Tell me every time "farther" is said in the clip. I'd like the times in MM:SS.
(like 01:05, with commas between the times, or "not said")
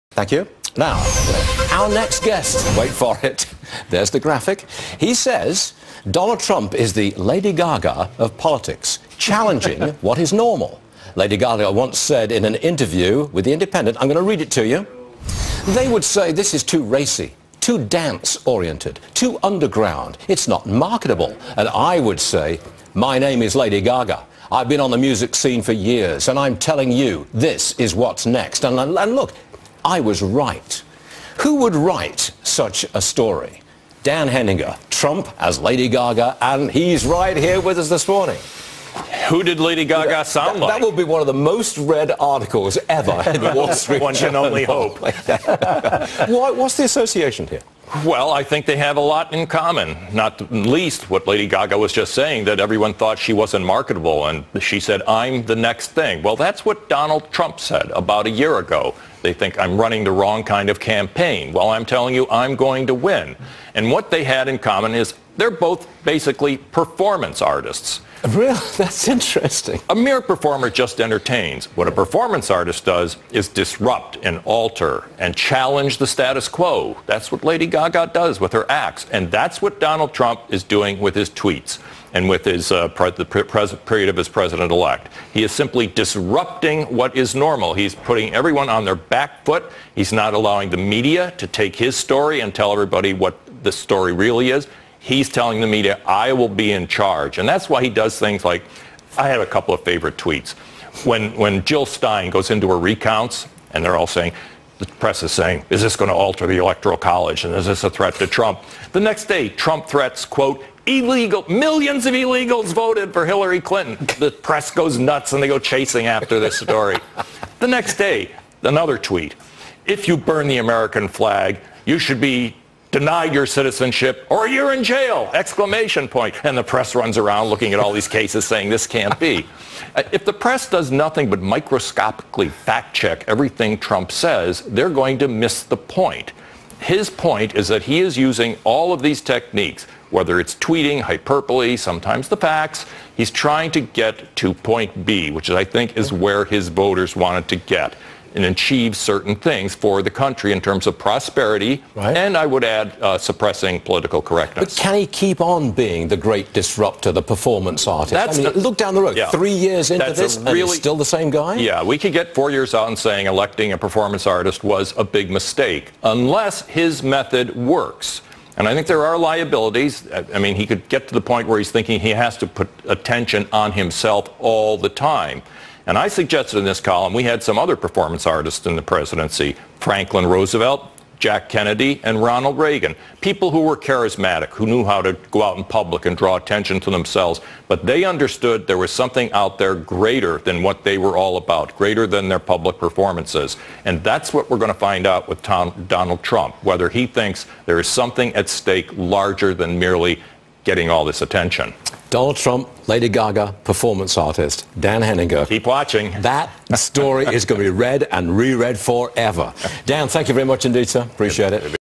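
not said.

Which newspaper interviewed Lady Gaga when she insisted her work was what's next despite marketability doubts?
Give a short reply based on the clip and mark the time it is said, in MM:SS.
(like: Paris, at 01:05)
The Independent, at 00:13.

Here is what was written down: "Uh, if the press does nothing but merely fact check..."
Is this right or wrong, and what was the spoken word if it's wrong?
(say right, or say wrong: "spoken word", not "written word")
wrong: "microscopically", not "merely".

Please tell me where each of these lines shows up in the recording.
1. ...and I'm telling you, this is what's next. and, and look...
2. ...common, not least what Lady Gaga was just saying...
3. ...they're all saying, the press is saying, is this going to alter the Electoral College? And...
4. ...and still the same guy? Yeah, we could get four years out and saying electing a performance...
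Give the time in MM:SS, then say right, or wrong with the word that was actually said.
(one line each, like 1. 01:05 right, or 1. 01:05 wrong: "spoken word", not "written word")
1. 00:26 right
2. 00:49 right
3. 01:43 right
4. 02:40 right.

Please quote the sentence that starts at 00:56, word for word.
Well, that's what Donald Trump said about a year ago.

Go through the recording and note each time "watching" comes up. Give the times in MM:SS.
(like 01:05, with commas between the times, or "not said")
03:25.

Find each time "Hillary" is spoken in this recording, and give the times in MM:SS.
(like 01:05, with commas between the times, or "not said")
01:53.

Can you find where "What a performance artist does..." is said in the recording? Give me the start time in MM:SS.
01:11.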